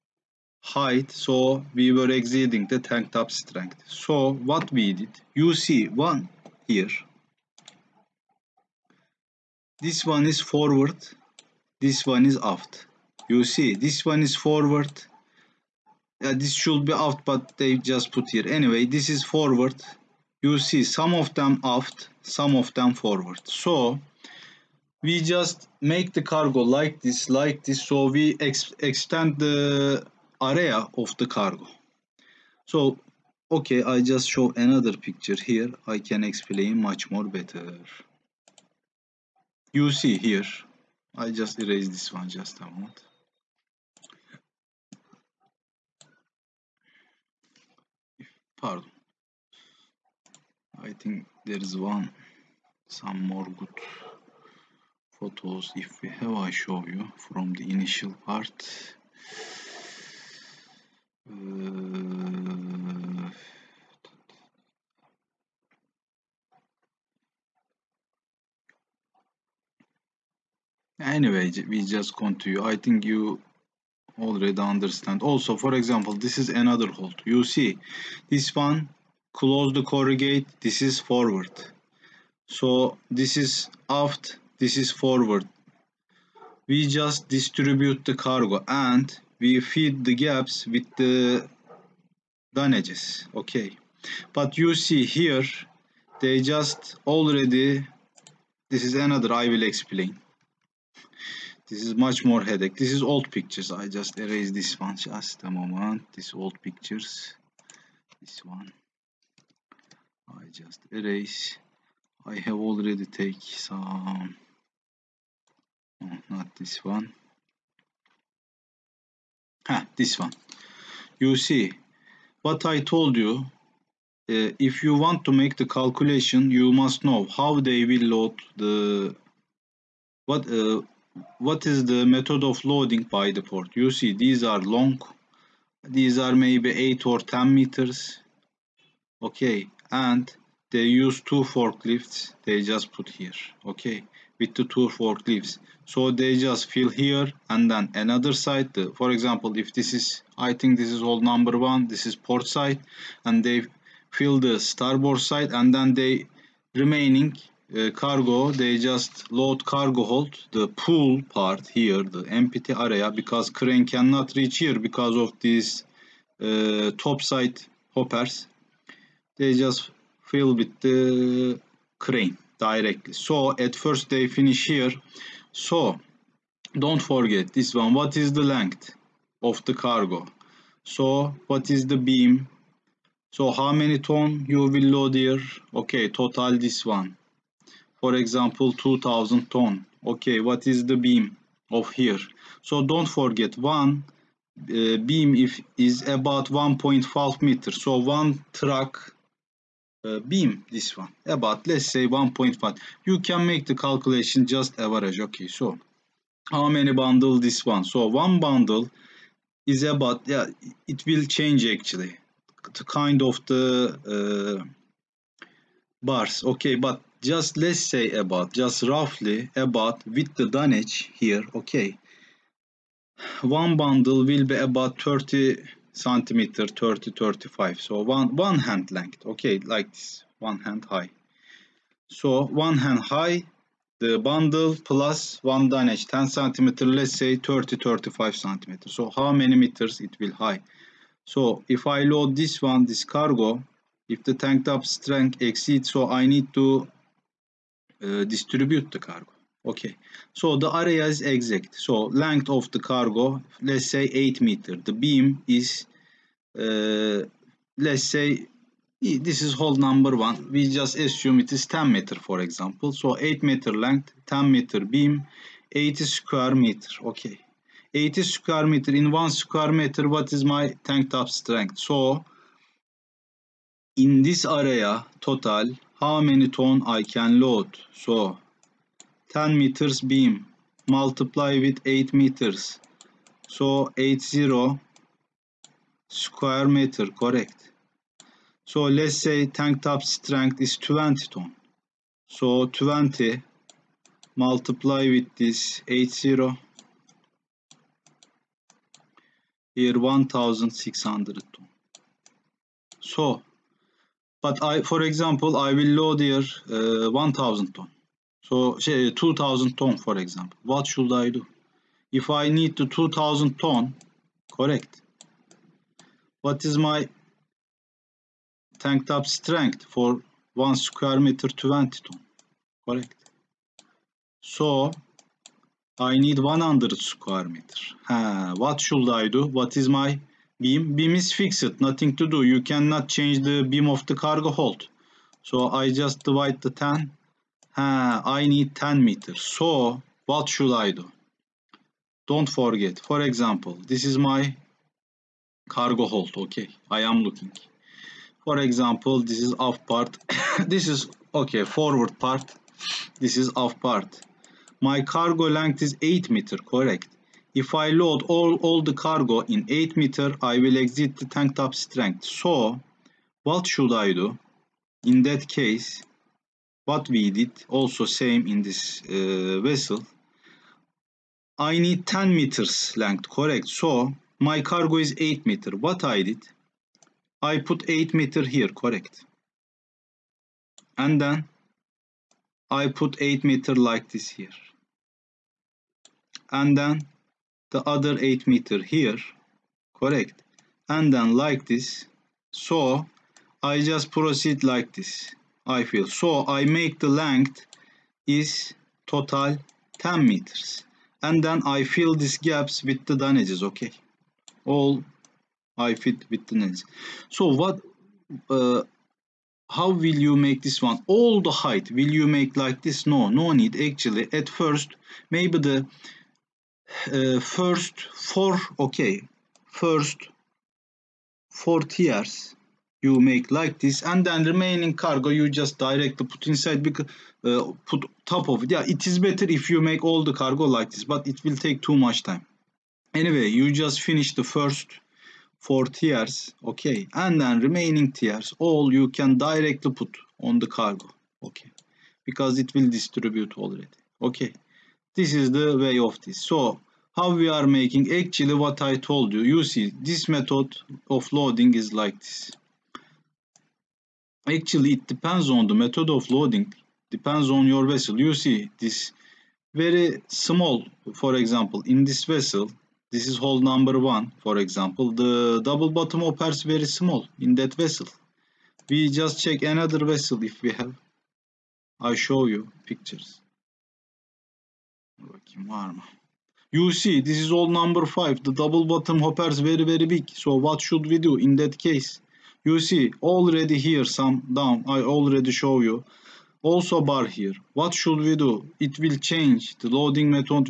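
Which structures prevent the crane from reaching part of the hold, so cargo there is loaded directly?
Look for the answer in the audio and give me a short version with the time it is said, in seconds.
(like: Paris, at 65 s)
Top side hoppers, at 166 s.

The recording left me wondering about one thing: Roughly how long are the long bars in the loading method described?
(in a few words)
8 or 10 meters.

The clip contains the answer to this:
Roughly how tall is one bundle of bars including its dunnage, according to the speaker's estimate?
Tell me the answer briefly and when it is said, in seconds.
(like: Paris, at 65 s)
30-35 centimeters, at 237 s.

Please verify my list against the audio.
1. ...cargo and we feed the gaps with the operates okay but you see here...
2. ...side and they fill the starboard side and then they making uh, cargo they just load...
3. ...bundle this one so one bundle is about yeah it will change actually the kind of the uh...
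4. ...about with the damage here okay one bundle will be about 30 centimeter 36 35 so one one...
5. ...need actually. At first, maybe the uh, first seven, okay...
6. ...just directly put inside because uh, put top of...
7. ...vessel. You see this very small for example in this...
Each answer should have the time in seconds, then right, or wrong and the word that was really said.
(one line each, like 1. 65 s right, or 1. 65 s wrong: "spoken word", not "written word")
1. 88 s wrong: "damages", not "operates"
2. 152 s wrong: "remaining", not "making"
3. 206 s right
4. 219 s wrong: "30", not "36"
5. 413 s wrong: "four", not "seven"
6. 425 s right
7. 457 s right.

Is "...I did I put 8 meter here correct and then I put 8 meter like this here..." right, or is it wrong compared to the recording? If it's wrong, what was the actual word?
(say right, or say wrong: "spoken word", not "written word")
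right.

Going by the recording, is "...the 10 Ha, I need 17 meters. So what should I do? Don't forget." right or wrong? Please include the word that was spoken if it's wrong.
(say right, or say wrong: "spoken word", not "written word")
wrong: "10", not "17".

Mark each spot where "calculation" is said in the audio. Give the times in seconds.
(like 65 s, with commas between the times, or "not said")
125 s, 203 s.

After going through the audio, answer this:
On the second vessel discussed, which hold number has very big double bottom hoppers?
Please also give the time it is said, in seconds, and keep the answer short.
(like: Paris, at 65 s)
5, at 477 s.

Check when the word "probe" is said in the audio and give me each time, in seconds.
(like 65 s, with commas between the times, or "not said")
not said.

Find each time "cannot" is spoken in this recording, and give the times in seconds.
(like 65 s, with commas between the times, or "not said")
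163 s, 332 s.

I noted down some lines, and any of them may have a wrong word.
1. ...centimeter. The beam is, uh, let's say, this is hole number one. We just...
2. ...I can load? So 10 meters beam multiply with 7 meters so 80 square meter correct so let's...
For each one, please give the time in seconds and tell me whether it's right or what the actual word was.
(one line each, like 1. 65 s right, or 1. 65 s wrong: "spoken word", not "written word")
1. 254 s wrong: "meter", not "centimeter"
2. 276 s wrong: "8", not "7".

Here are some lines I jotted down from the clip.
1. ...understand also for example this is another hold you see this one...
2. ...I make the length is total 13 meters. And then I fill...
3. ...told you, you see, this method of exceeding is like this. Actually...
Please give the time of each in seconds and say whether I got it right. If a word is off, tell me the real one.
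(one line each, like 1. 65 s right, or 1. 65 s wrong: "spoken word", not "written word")
1. 74 s right
2. 396 s wrong: "10", not "13"
3. 449 s wrong: "loading", not "exceeding".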